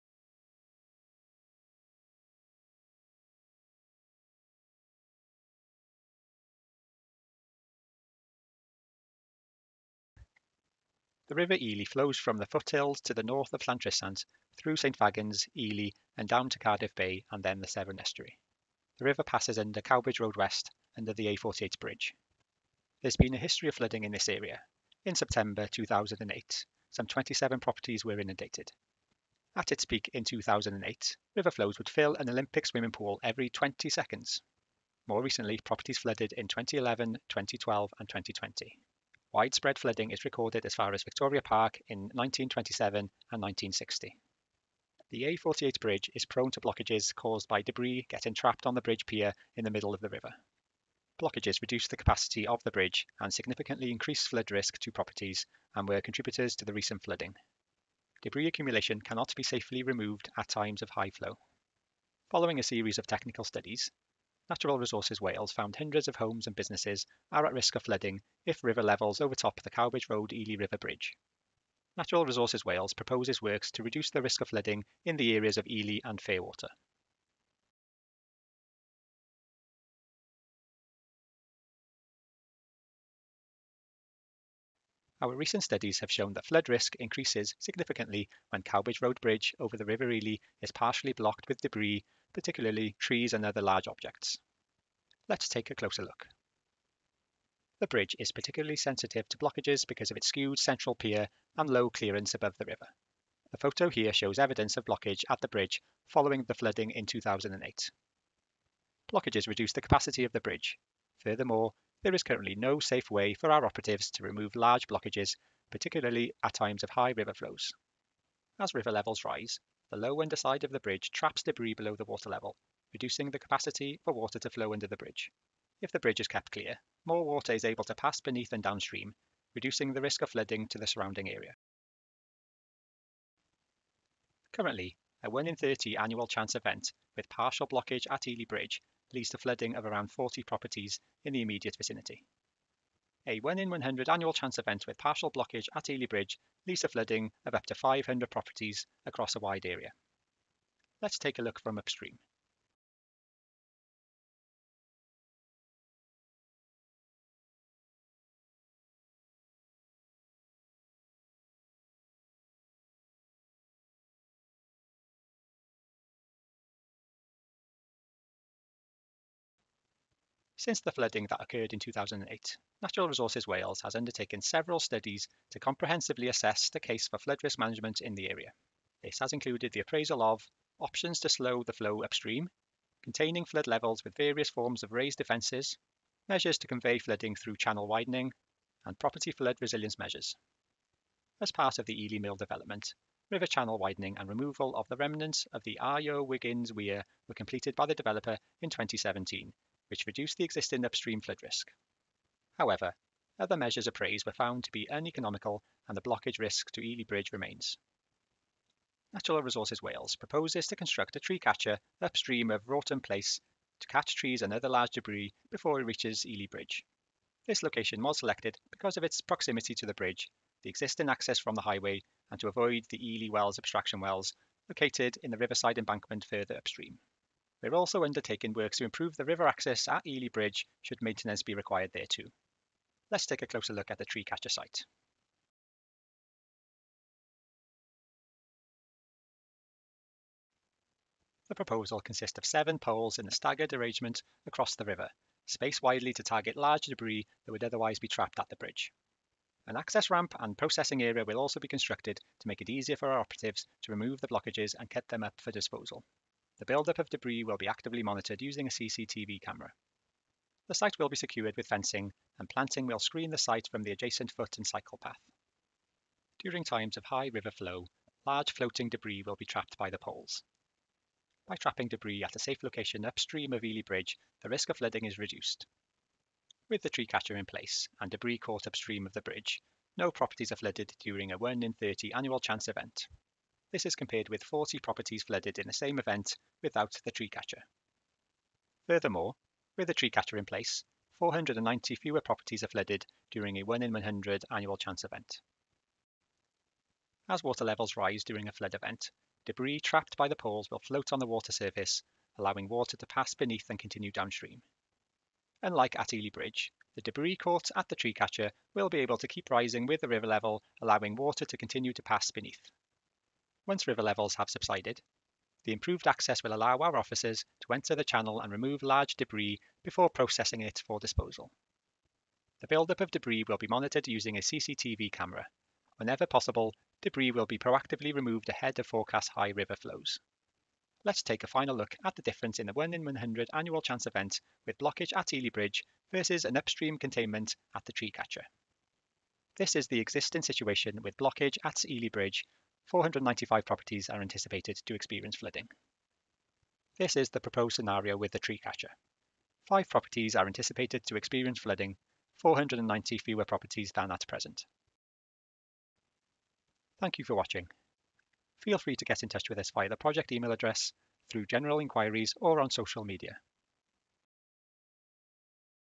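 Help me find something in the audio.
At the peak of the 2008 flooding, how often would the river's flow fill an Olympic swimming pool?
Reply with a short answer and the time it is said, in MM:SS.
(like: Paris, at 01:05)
every 20 seconds, at 00:33.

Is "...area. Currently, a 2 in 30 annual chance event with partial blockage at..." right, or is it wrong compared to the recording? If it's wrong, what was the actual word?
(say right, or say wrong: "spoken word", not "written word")
wrong: "1", not "2".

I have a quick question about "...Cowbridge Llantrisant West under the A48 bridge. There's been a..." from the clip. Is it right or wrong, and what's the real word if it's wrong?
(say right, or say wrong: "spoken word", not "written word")
wrong: "Road", not "Llantrisant".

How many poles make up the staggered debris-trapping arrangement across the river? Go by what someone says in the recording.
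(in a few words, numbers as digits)
7.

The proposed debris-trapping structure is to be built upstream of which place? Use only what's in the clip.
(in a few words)
Rawton Place.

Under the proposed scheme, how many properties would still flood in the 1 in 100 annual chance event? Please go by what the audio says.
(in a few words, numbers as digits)
5.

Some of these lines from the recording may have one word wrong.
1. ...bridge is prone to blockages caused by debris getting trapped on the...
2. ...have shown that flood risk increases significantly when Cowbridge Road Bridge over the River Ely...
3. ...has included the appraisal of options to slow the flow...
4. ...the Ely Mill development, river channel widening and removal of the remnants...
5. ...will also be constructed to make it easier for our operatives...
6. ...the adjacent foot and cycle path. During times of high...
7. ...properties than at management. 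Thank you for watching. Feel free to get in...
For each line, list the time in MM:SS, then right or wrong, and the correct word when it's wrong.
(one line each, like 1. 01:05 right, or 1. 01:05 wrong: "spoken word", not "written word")
1. 00:45 right
2. 01:25 right
3. 02:59 right
4. 03:11 right
5. 04:11 right
6. 04:23 right
7. 05:53 wrong: "present", not "management".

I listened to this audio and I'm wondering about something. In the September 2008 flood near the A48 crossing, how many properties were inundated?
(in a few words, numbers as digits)
27.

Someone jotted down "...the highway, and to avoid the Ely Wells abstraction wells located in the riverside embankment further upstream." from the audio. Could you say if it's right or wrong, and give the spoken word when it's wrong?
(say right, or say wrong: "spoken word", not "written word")
right.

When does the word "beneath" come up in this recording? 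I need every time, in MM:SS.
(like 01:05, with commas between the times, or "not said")
02:08, 05:03, 05:12.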